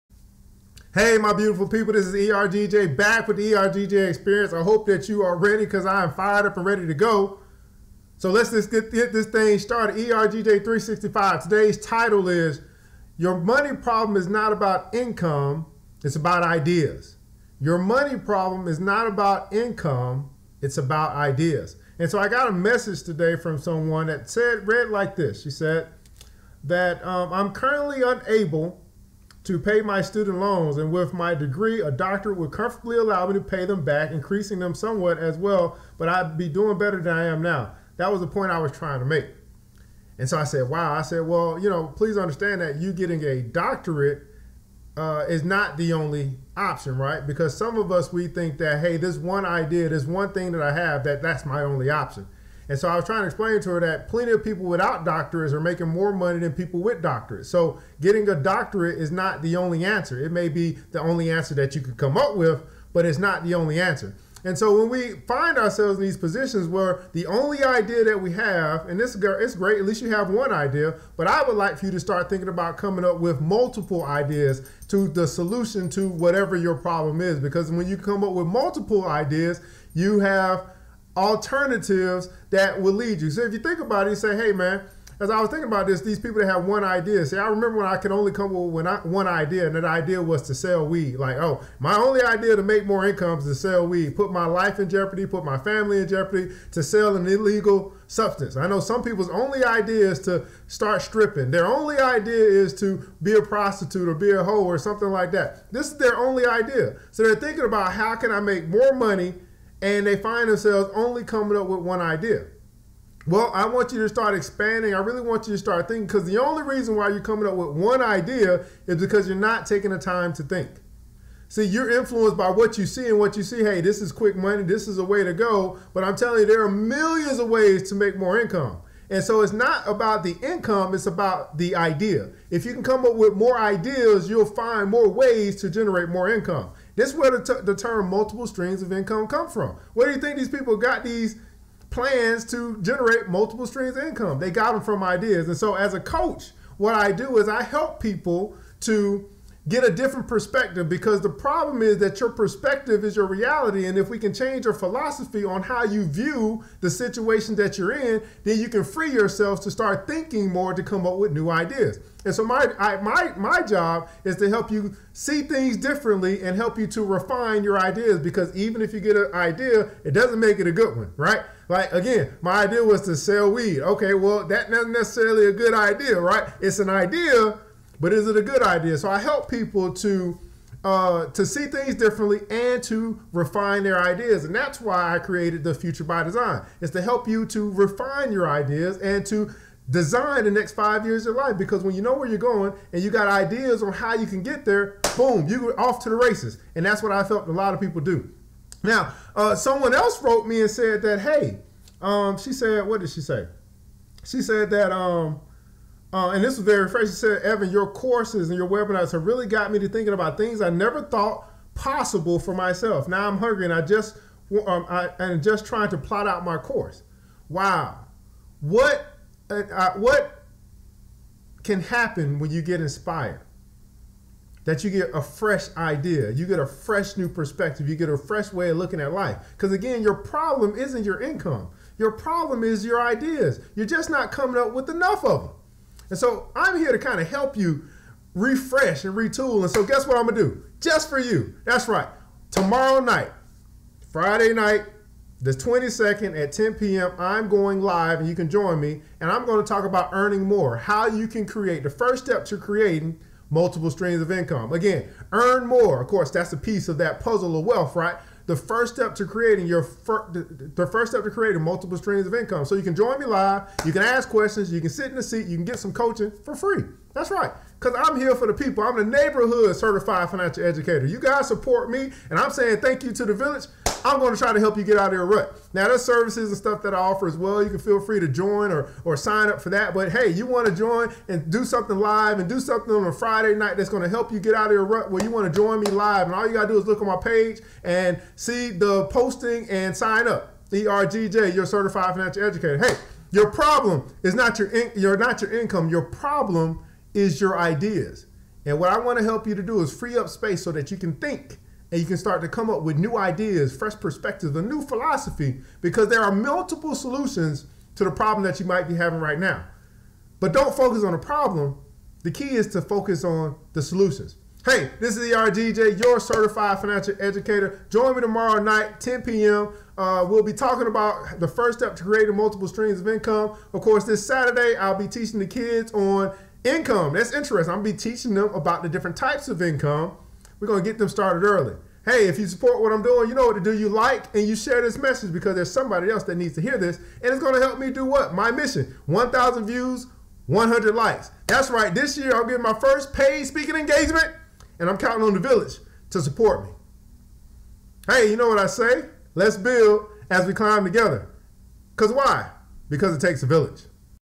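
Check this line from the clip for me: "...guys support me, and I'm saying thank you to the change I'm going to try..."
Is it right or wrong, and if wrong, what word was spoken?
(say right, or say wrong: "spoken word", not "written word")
wrong: "village", not "change".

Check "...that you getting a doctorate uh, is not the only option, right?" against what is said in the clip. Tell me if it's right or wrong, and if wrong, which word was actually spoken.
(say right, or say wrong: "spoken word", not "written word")
right.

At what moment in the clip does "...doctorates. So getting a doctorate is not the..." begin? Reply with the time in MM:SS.
00:57.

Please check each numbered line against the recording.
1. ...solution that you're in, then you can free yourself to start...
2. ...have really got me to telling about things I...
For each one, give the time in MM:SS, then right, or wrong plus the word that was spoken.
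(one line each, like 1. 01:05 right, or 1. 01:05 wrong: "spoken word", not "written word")
1. 02:36 wrong: "situation", not "solution"
2. 03:29 wrong: "thinking", not "telling".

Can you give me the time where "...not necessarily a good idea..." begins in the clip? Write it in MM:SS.
02:54.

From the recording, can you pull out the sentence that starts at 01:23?
So if you think about it, you say, hey, man, as I was thinking about this, these people that have one idea.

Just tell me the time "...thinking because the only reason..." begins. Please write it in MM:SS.
01:55.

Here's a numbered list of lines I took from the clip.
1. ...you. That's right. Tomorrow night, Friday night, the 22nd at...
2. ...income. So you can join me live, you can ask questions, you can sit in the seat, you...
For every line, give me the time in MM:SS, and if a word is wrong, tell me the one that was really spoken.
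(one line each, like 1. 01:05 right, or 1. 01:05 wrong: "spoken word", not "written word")
1. 04:01 right
2. 04:22 right.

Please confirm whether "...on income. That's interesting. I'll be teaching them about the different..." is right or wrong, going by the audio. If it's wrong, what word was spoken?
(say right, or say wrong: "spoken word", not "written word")
right.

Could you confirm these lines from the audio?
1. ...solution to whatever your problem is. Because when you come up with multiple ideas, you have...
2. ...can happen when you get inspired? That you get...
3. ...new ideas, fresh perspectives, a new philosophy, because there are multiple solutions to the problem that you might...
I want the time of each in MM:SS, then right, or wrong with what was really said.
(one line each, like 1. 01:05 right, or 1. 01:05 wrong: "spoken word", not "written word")
1. 01:15 right
2. 03:41 right
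3. 05:02 right.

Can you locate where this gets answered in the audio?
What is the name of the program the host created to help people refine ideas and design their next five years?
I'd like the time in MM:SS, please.
03:05.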